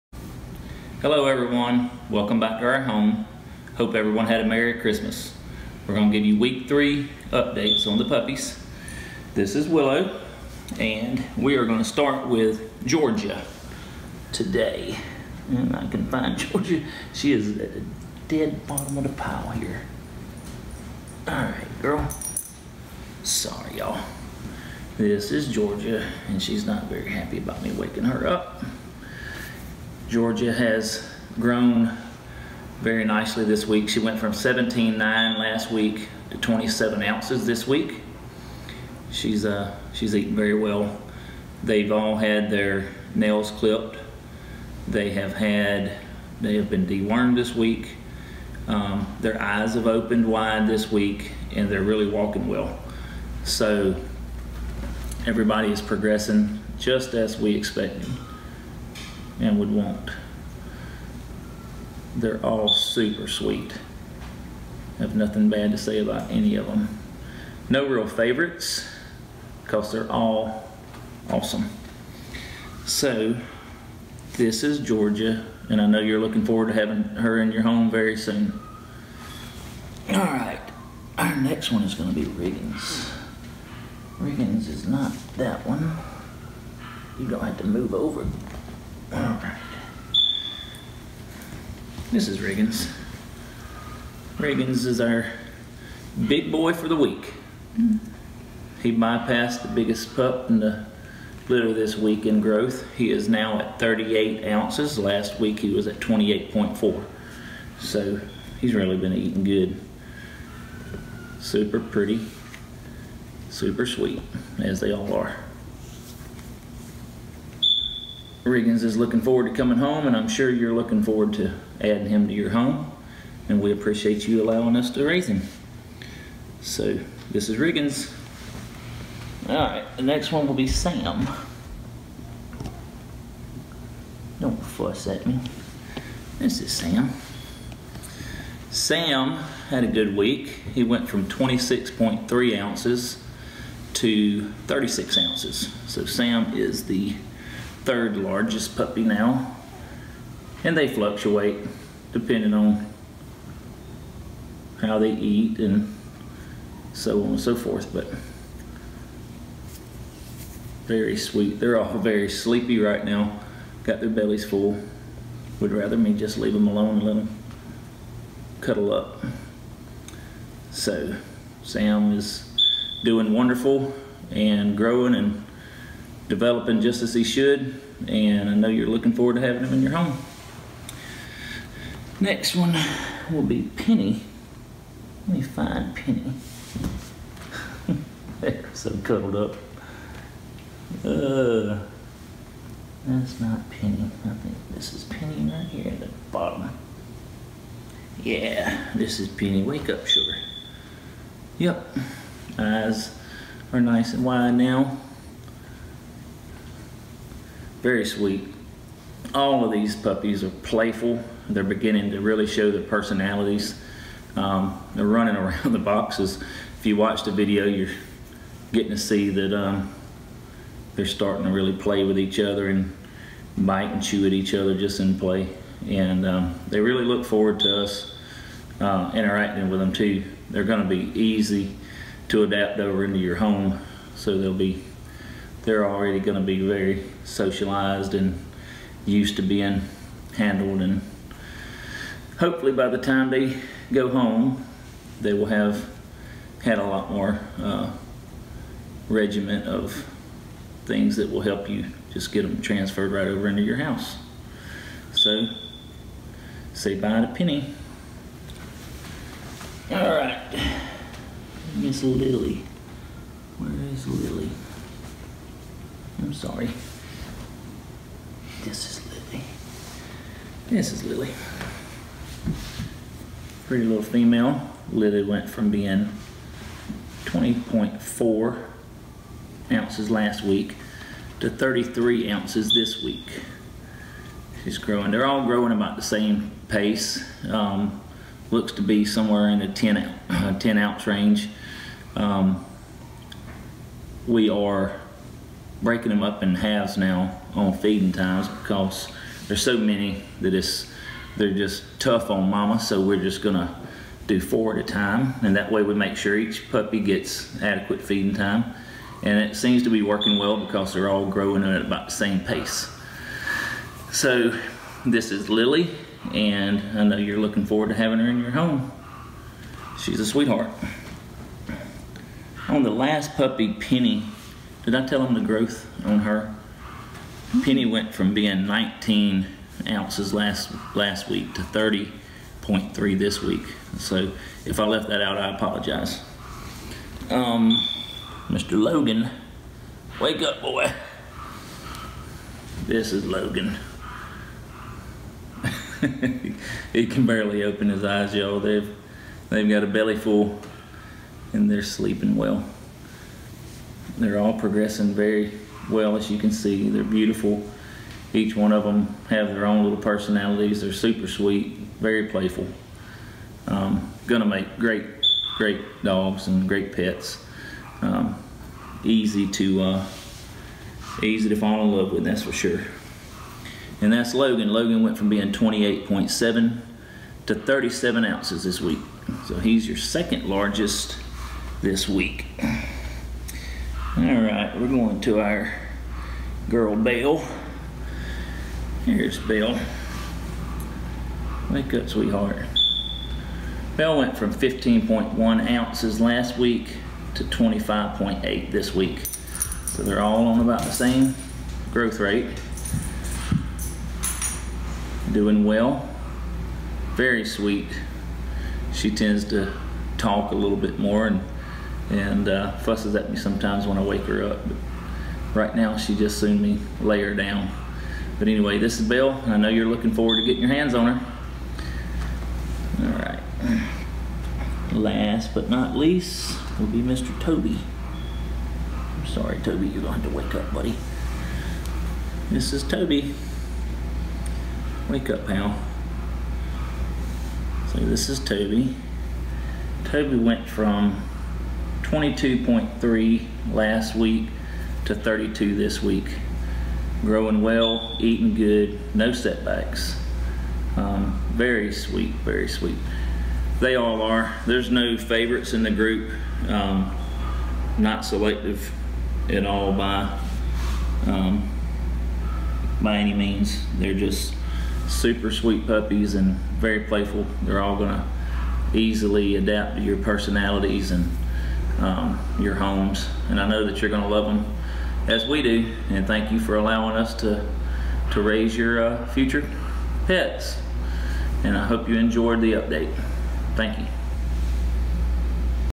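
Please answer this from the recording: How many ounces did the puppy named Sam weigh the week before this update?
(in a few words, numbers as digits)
26.3.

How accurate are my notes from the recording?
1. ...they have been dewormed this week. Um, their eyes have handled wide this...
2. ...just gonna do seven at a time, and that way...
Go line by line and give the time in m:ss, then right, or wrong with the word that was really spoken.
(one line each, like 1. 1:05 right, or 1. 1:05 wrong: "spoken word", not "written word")
1. 0:46 wrong: "opened", not "handled"
2. 5:03 wrong: "four", not "seven".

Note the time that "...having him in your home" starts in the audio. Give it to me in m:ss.
2:59.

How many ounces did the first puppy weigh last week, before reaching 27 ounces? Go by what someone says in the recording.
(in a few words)
17.9.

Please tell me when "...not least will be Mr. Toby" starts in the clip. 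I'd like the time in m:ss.
7:05.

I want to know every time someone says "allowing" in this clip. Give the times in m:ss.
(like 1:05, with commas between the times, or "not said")
2:04, 7:56.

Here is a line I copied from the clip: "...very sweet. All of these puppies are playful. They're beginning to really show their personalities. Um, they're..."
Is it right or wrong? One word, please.
right.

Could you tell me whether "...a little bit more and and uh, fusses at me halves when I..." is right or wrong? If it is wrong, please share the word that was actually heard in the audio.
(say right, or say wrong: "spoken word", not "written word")
wrong: "sometimes", not "halves".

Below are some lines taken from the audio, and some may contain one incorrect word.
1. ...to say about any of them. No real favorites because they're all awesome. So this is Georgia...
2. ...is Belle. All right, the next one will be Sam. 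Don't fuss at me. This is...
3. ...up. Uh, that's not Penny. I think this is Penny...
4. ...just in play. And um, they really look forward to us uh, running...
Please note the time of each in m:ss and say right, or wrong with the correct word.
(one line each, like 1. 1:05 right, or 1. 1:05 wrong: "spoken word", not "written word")
1. 1:05 right
2. 2:07 wrong: "Riggins", not "Belle"
3. 3:09 right
4. 3:44 wrong: "interacting", not "running".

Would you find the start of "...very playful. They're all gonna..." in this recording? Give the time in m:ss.
7:46.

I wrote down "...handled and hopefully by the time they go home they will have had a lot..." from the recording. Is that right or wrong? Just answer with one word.
right.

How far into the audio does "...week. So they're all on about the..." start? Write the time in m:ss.
6:38.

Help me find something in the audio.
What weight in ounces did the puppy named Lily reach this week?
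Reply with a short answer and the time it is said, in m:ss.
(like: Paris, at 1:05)
33, at 4:41.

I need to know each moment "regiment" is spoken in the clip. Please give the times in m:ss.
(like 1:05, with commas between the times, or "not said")
4:09.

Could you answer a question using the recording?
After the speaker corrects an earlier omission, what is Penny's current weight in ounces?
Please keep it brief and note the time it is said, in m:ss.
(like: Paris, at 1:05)
30.3, at 5:31.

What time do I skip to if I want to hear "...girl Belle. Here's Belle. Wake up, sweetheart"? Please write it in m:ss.
6:26.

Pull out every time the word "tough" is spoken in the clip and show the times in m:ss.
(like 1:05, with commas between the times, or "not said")
5:01.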